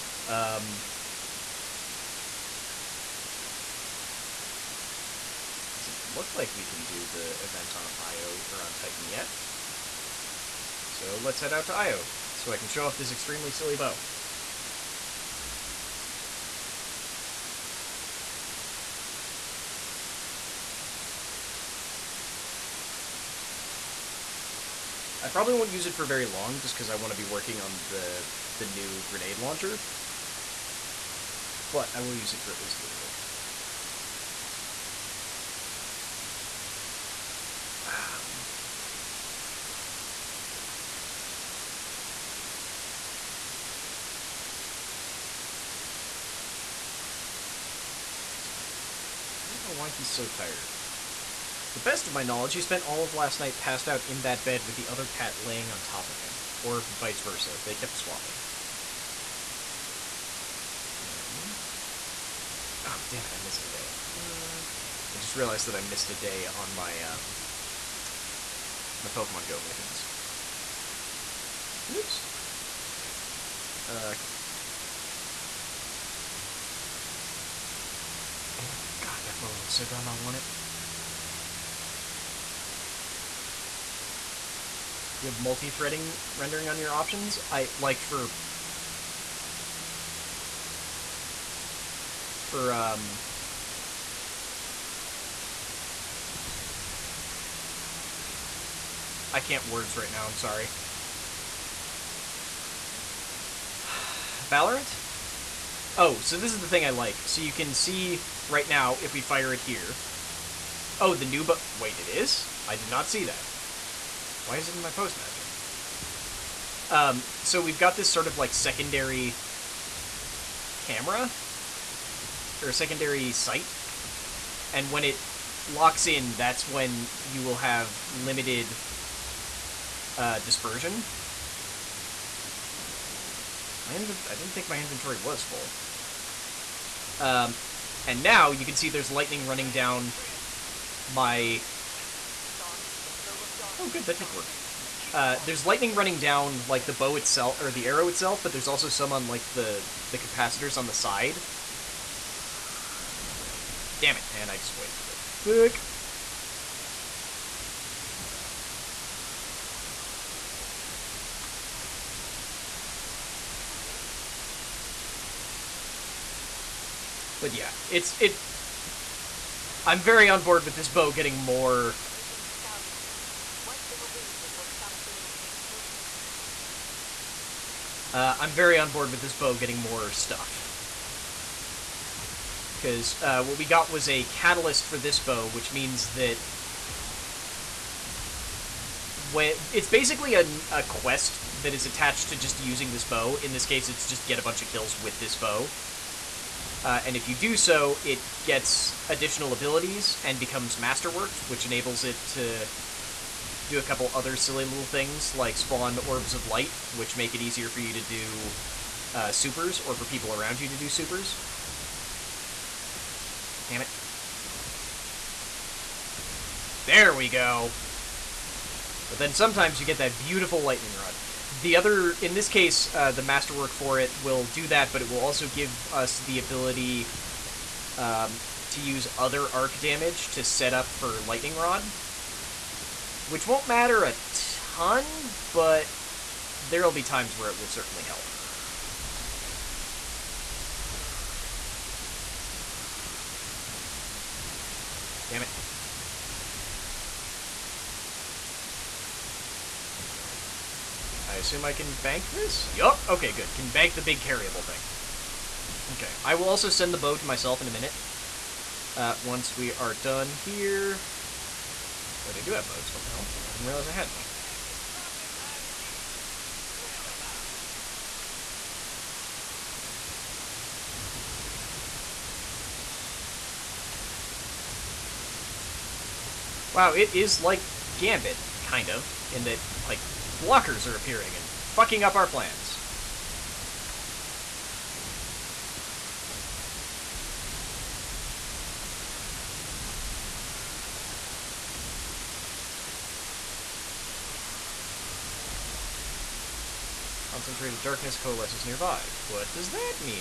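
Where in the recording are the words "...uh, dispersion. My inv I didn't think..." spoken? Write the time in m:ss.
2:10.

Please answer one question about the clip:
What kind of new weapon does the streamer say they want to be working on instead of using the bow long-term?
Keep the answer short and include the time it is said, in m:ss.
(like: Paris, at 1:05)
Grenade launcher, at 0:29.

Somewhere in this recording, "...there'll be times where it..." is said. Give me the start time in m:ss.
3:56.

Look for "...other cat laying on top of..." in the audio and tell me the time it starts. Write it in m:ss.
0:54.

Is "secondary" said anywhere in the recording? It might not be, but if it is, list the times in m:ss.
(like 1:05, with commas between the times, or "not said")
1:58, 2:02.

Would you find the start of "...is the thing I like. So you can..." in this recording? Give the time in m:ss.
1:46.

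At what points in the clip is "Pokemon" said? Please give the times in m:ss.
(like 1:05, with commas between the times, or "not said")
1:09.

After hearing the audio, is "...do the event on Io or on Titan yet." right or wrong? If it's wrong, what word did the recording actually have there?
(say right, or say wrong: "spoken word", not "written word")
right.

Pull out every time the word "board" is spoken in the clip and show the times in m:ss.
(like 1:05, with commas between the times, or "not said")
2:50, 2:58.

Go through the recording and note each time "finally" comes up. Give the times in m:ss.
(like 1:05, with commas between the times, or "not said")
not said.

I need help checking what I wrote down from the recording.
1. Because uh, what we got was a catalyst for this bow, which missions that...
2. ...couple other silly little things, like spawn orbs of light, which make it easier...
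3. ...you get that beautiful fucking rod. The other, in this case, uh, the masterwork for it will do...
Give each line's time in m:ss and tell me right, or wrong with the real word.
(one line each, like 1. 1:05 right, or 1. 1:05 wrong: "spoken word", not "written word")
1. 3:02 wrong: "means", not "missions"
2. 3:23 right
3. 3:39 wrong: "lightning", not "fucking".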